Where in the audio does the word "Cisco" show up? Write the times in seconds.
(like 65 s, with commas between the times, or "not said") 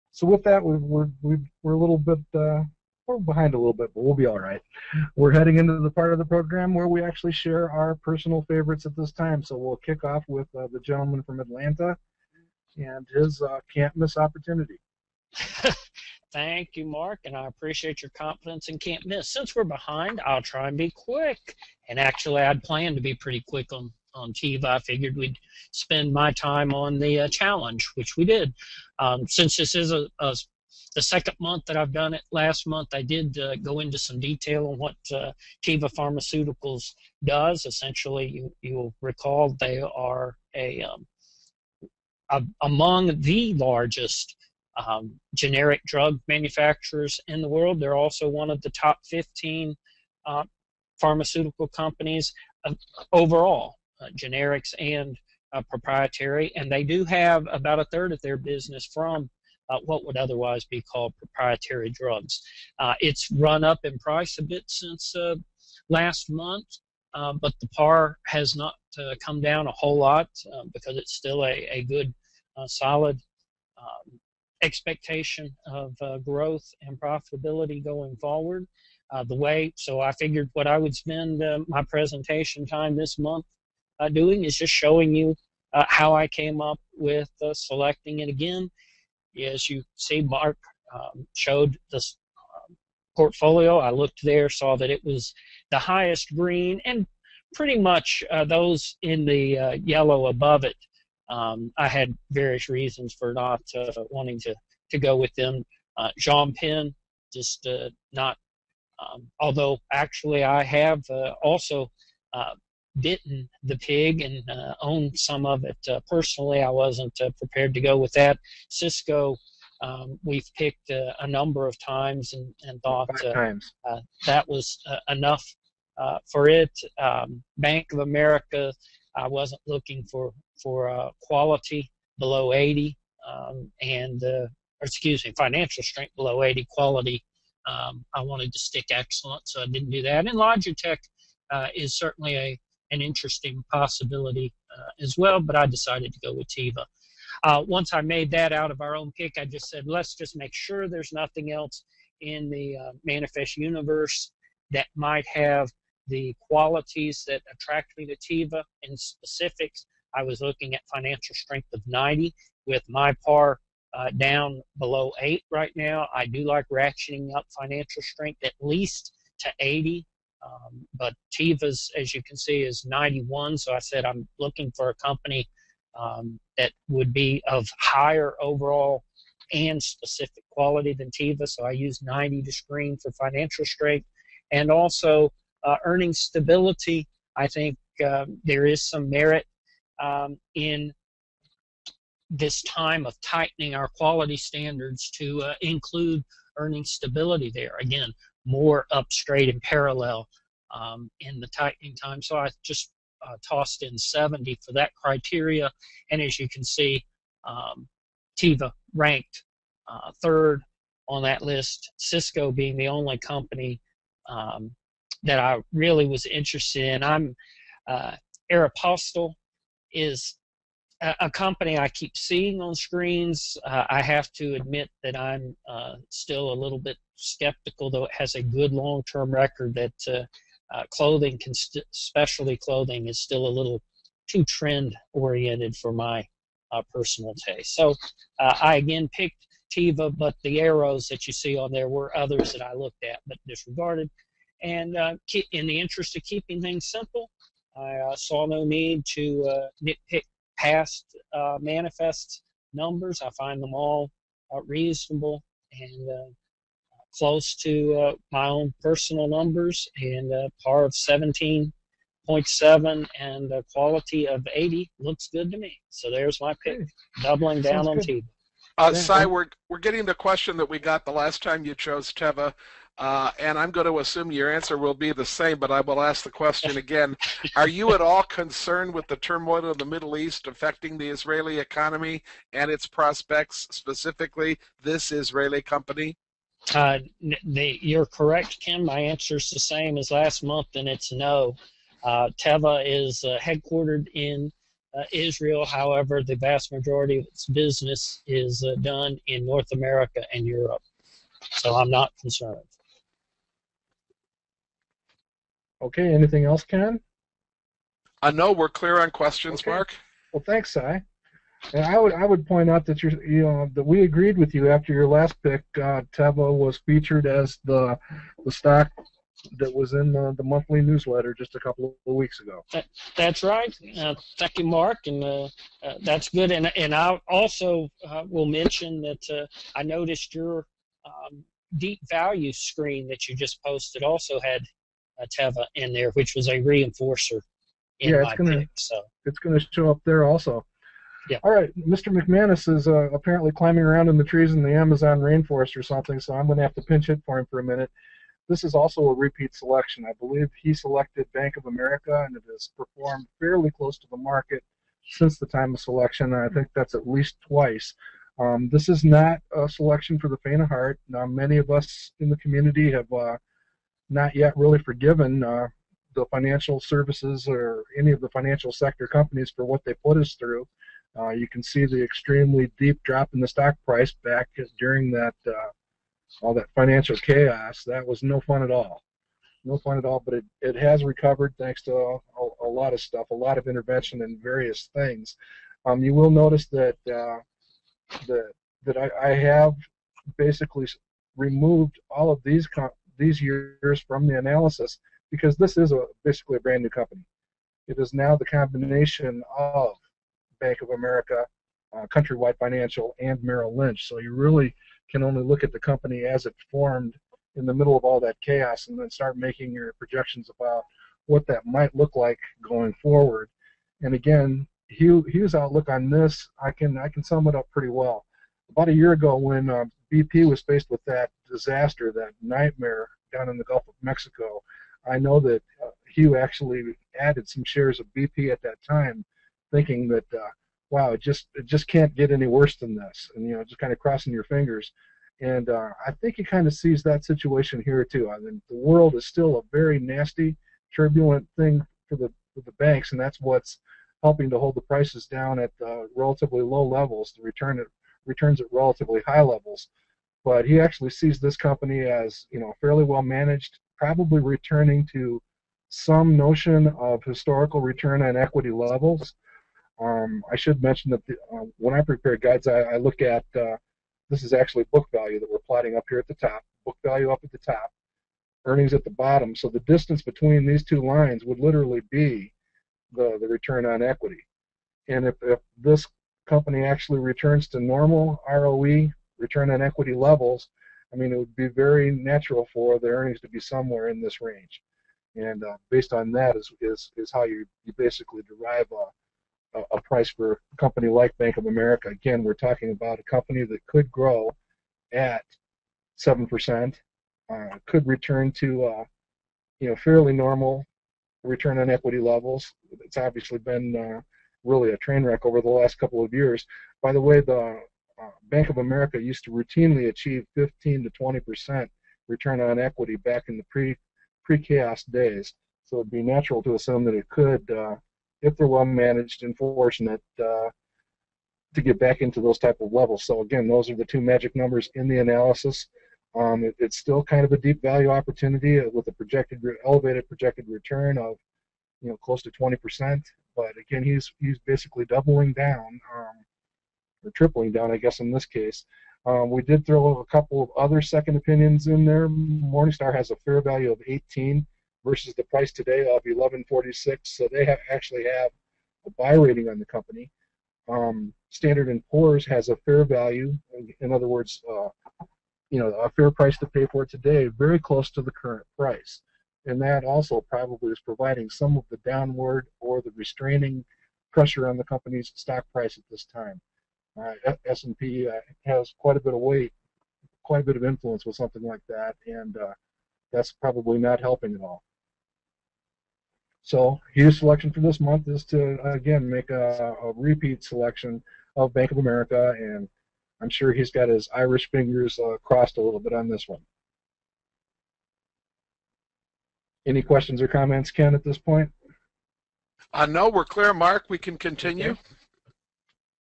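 118 s, 211 s.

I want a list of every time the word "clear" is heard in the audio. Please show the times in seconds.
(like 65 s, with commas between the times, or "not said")
308 s, 593 s.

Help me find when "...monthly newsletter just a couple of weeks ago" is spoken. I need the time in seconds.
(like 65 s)
320 s.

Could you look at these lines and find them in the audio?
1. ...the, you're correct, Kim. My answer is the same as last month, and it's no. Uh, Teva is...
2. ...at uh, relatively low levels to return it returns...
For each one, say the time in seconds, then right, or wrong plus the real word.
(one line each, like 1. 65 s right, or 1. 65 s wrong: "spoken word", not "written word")
1. 287 s right
2. 445 s right.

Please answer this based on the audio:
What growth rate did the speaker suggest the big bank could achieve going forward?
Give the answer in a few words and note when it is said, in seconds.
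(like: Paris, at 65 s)
7%, at 496 s.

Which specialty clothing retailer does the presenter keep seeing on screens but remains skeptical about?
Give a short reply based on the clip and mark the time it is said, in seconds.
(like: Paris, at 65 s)
Aeropostale, at 218 s.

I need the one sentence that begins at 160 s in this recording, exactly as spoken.
I was looking at financial strength of 90 with my par uh, down below 8 right now.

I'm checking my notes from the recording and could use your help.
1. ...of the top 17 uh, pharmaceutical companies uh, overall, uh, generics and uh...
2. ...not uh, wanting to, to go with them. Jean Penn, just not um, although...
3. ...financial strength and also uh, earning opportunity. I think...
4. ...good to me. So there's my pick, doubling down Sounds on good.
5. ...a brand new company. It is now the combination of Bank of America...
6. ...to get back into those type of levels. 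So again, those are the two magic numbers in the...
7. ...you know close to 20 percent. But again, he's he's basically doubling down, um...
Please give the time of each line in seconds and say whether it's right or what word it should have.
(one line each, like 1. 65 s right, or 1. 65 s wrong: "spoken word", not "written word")
1. 48 s wrong: "15", not "17"
2. 103 s right
3. 183 s wrong: "stability", not "opportunity"
4. 265 s right
5. 396 s right
6. 521 s right
7. 532 s right.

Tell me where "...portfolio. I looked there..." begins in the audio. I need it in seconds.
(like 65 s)
93 s.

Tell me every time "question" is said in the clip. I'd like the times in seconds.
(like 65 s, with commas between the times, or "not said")
270 s, 276 s, 309 s, 590 s.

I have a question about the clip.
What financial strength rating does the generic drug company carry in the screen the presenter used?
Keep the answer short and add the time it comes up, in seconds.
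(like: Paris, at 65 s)
91, at 172 s.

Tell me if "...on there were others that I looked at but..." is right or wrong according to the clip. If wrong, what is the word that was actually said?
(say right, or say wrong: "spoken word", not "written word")
right.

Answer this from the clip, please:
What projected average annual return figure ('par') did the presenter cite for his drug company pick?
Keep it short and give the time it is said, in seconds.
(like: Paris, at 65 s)
17.7, at 260 s.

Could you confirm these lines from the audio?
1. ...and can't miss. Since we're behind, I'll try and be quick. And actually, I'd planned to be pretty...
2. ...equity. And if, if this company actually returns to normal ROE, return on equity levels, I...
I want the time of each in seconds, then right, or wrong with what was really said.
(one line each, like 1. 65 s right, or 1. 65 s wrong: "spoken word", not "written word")
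1. 18 s right
2. 474 s right.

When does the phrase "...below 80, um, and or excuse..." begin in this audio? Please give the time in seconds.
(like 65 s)
132 s.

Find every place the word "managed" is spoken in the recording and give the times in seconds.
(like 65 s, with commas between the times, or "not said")
453 s, 518 s.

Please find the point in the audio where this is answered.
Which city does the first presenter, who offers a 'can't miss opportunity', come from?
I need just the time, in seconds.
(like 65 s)
11 s.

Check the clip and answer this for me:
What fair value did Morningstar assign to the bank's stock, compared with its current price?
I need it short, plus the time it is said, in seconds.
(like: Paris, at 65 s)
18, at 544 s.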